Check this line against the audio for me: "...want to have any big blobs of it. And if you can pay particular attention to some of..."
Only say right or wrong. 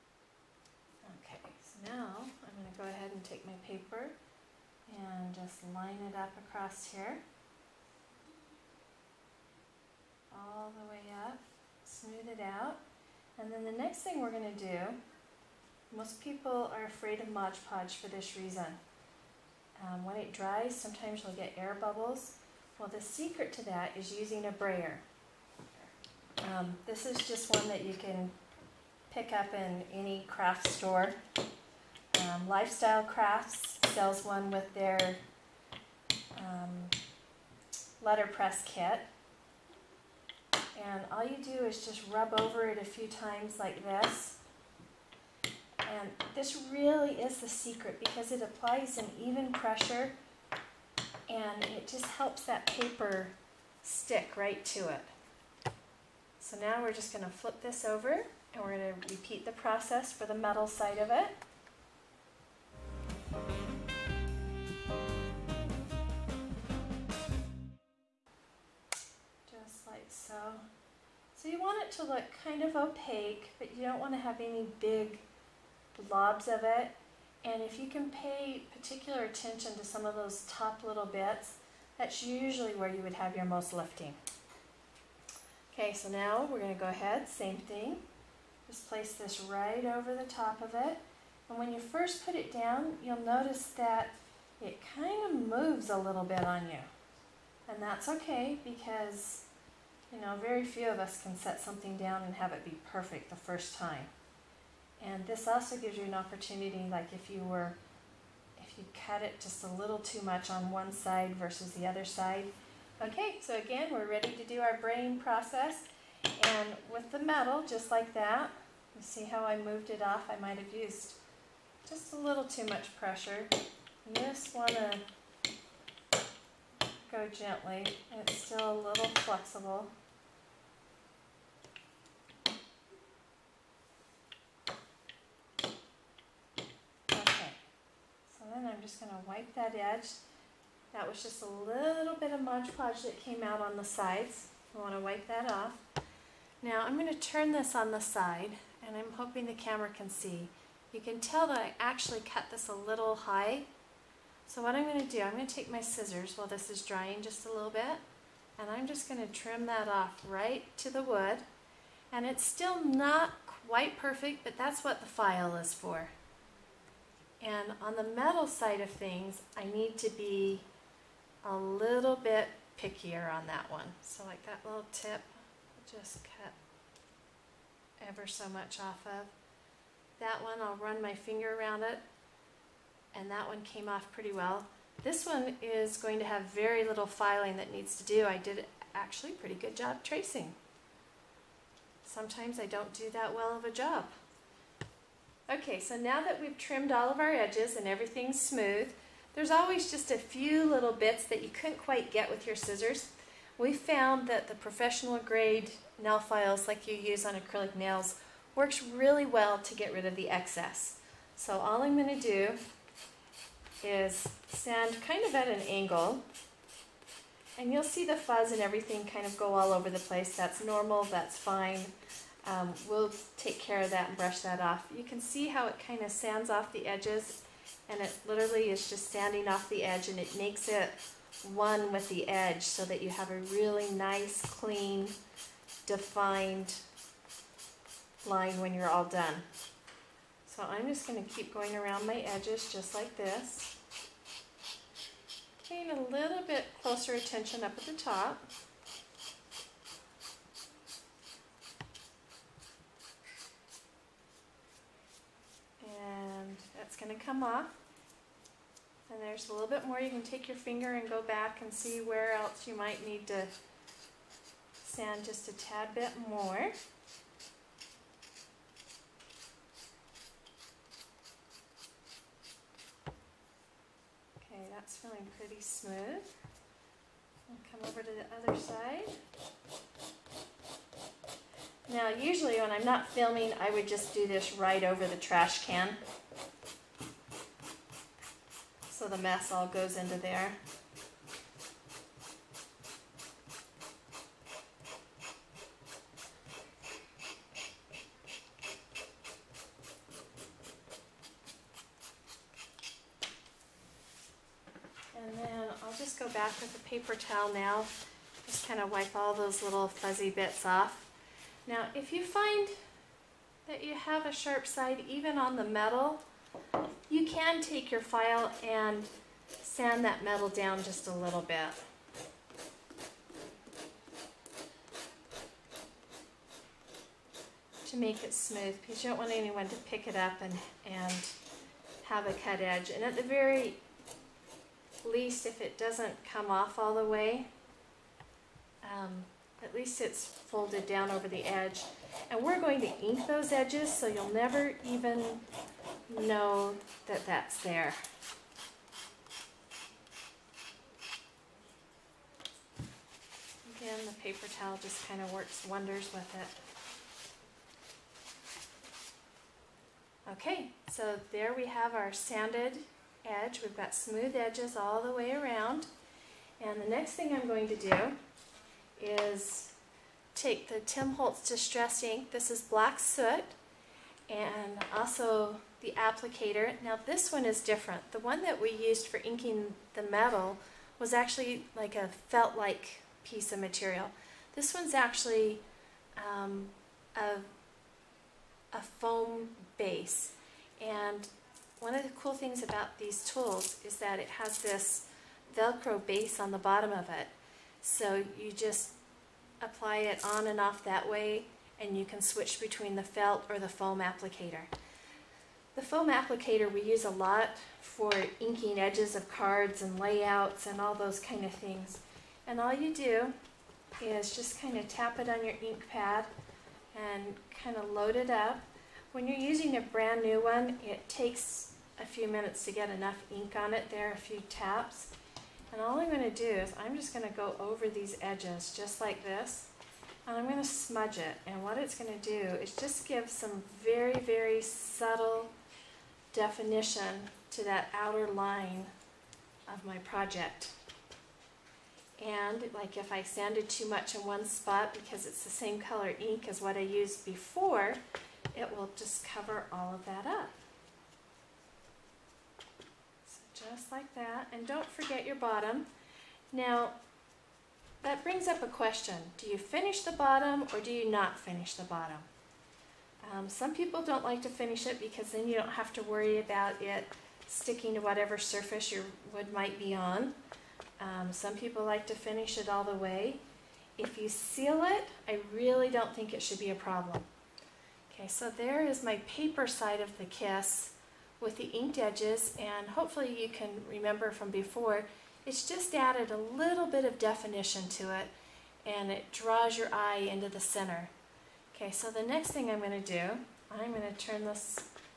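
right.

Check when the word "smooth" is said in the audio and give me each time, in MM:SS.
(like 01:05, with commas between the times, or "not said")
00:11, 03:18, 04:35, 05:28, 06:03.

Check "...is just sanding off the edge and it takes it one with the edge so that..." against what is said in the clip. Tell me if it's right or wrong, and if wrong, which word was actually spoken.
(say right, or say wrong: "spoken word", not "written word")
wrong: "makes", not "takes".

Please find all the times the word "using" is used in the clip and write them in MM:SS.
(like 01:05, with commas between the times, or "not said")
00:24, 06:59.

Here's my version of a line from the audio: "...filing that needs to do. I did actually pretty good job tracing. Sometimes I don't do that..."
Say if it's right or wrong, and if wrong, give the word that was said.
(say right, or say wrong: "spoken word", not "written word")
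right.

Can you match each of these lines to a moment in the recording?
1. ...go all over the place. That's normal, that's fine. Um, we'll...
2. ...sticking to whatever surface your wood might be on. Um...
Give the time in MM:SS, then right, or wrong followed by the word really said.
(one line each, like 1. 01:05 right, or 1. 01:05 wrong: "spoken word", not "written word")
1. 03:39 right
2. 07:47 right.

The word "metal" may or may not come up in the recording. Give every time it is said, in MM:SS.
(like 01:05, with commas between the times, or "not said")
01:00, 01:57, 02:48, 05:15, 05:20, 06:20.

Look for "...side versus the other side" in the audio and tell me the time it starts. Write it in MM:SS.
01:50.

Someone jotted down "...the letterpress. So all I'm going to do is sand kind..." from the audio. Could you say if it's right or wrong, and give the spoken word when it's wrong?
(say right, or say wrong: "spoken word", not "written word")
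wrong: "excess", not "letterpress".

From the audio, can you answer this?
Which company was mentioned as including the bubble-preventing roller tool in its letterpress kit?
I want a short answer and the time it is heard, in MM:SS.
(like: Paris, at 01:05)
Lifestyle Crafts, at 00:32.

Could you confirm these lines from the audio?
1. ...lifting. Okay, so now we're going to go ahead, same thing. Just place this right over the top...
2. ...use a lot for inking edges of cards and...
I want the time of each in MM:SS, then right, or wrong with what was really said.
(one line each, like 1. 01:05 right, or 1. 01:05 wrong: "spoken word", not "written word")
1. 01:23 right
2. 06:46 right.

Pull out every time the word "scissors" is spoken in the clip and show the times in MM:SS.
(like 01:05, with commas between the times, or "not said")
02:35, 03:22.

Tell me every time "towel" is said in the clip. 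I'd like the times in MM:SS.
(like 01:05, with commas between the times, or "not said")
05:07, 05:54.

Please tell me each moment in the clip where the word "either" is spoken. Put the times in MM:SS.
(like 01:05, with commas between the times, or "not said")
not said.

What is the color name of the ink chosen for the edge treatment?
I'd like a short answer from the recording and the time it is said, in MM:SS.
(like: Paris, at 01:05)
Black Soot, at 06:12.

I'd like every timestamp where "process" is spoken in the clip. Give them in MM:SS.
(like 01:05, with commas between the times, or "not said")
00:59, 01:55.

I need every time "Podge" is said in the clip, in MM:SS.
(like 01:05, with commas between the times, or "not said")
00:17, 02:22.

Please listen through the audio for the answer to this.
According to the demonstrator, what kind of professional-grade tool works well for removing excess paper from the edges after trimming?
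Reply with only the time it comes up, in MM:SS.
03:26.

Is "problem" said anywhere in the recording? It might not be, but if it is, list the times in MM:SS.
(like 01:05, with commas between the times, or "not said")
07:56.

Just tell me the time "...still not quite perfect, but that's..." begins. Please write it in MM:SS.
02:42.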